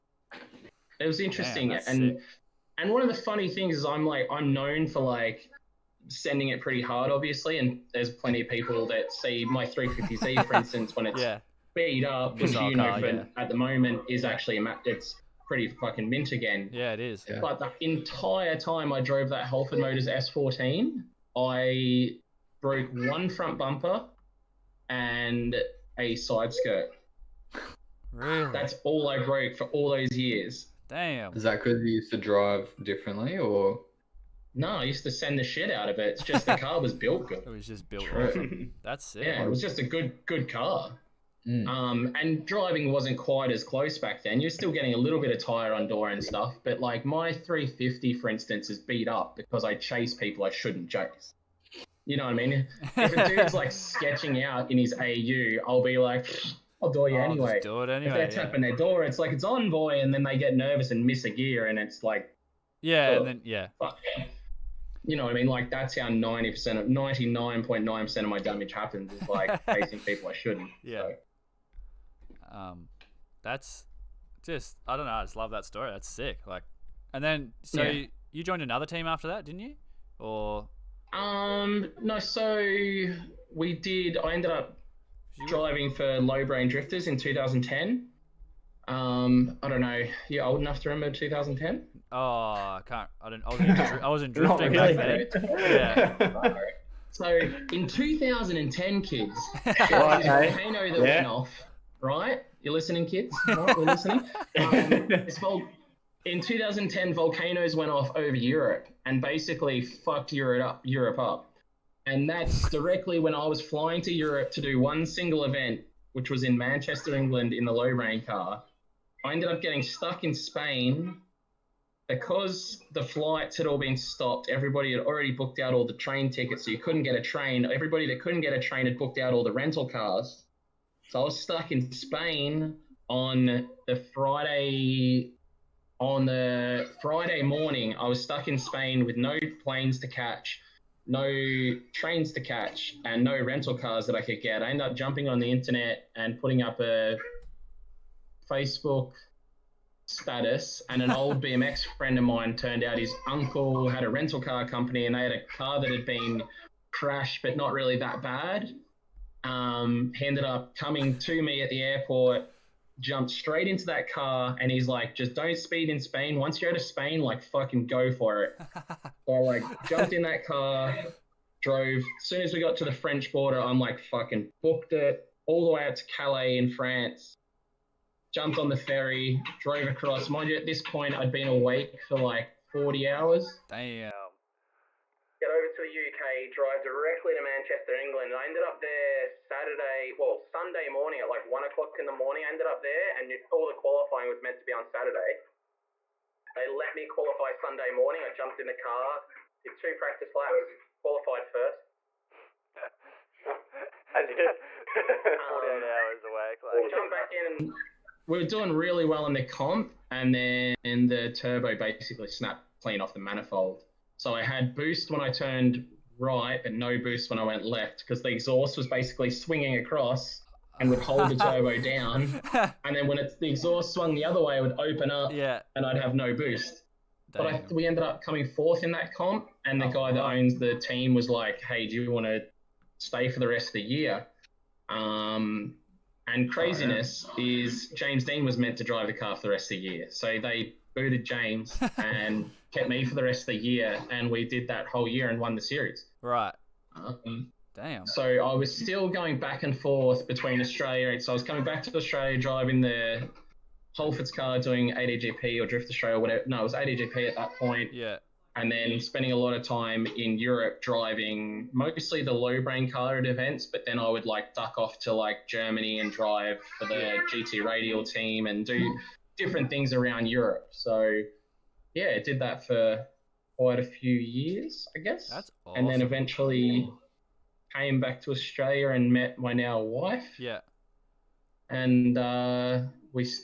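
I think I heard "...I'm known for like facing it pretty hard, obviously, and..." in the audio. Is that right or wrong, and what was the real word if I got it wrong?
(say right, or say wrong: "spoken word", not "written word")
wrong: "sending", not "facing".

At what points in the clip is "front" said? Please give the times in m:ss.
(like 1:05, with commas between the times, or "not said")
0:23.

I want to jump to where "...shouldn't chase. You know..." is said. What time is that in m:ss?
0:50.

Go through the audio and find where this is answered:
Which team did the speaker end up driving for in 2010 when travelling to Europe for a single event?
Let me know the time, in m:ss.
1:26.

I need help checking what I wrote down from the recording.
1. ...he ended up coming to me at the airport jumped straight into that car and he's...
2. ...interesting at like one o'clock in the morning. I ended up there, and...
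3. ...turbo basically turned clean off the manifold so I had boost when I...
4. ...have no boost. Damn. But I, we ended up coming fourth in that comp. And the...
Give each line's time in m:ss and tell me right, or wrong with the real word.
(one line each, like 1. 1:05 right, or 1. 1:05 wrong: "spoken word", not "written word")
1. 2:40 right
2. 3:10 wrong: "morning", not "interesting"
3. 3:31 wrong: "snapped", not "turned"
4. 3:45 right.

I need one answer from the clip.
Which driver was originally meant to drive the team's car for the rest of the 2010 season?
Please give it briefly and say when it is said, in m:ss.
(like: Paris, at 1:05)
James Deane, at 3:57.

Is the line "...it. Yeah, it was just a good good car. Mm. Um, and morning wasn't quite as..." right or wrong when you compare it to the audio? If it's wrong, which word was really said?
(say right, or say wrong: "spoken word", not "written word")
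wrong: "driving", not "morning".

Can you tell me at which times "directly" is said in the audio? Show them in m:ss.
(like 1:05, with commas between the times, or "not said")
1:52, 3:06.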